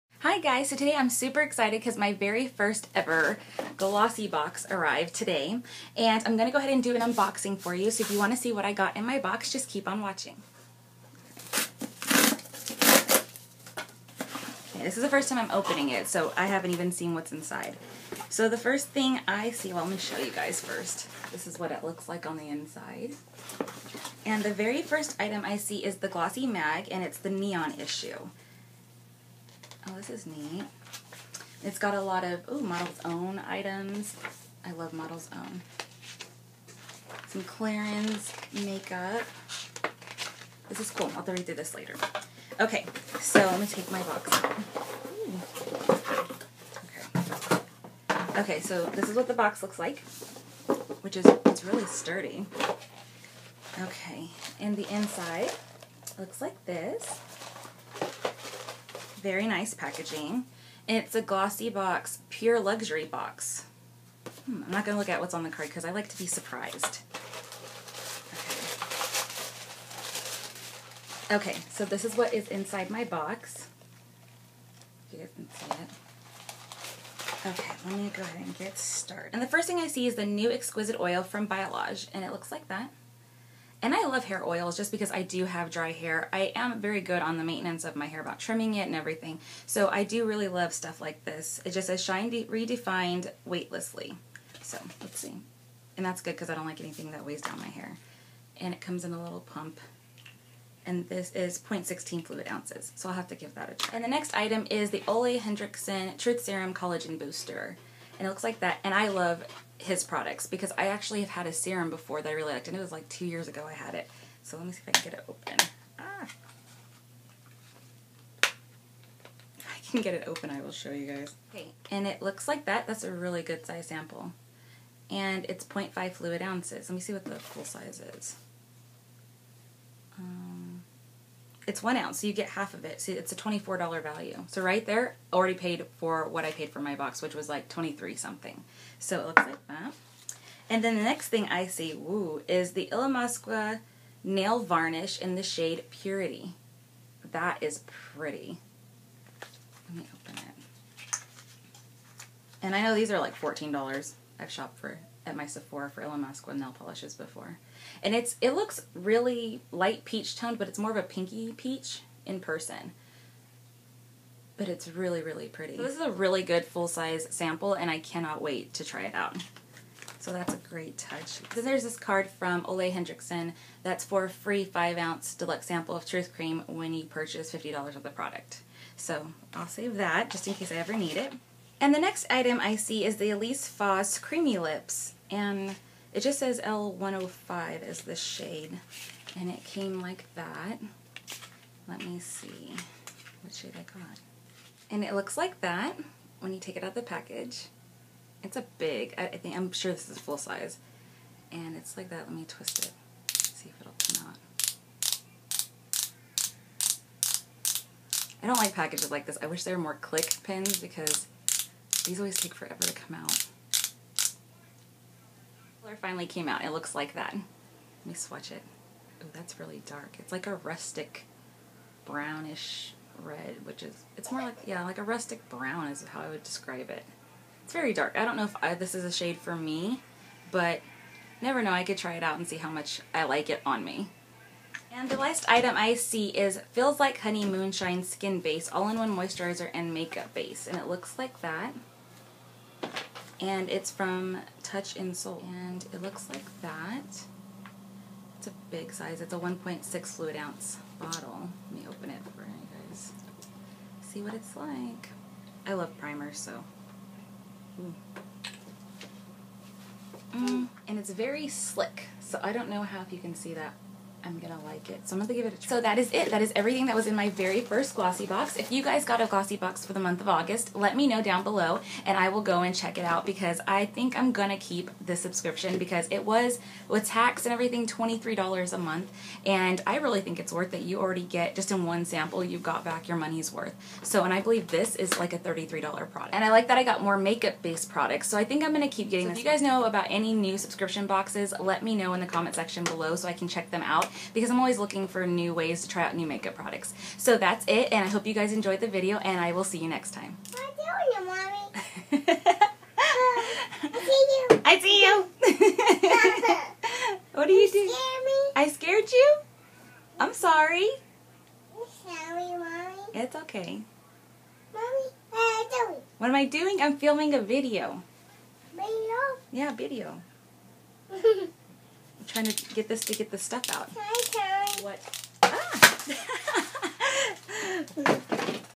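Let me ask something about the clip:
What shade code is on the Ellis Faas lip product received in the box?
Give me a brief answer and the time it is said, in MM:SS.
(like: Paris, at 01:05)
L105, at 03:06.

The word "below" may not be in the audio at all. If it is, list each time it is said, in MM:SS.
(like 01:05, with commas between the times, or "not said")
04:31, 04:52.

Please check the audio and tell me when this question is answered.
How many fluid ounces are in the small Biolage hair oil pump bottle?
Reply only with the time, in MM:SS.
01:41.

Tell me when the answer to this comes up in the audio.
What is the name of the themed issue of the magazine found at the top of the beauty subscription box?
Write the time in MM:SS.
00:27.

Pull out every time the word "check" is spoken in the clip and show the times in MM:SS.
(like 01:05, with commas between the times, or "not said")
04:32, 04:53.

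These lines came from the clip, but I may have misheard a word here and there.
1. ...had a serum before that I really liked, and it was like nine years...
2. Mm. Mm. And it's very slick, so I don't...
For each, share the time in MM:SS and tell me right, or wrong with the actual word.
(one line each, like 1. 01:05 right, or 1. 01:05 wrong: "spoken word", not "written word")
1. 01:51 wrong: "two", not "nine"
2. 04:17 right.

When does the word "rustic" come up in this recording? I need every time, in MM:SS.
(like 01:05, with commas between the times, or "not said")
03:40, 03:45.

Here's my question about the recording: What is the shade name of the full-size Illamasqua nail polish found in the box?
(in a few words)
Purity.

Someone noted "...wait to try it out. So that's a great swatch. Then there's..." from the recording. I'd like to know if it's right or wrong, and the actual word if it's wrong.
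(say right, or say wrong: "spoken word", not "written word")
wrong: "touch", not "swatch".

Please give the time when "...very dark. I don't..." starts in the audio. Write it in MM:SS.
03:47.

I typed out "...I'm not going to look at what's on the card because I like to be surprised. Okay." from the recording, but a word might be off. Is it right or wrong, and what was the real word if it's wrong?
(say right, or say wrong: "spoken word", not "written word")
right.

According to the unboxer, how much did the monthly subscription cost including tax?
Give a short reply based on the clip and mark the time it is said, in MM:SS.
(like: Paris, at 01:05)
$23, at 04:37.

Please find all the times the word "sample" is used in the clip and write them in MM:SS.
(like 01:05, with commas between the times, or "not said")
02:03, 02:47, 02:55, 04:42.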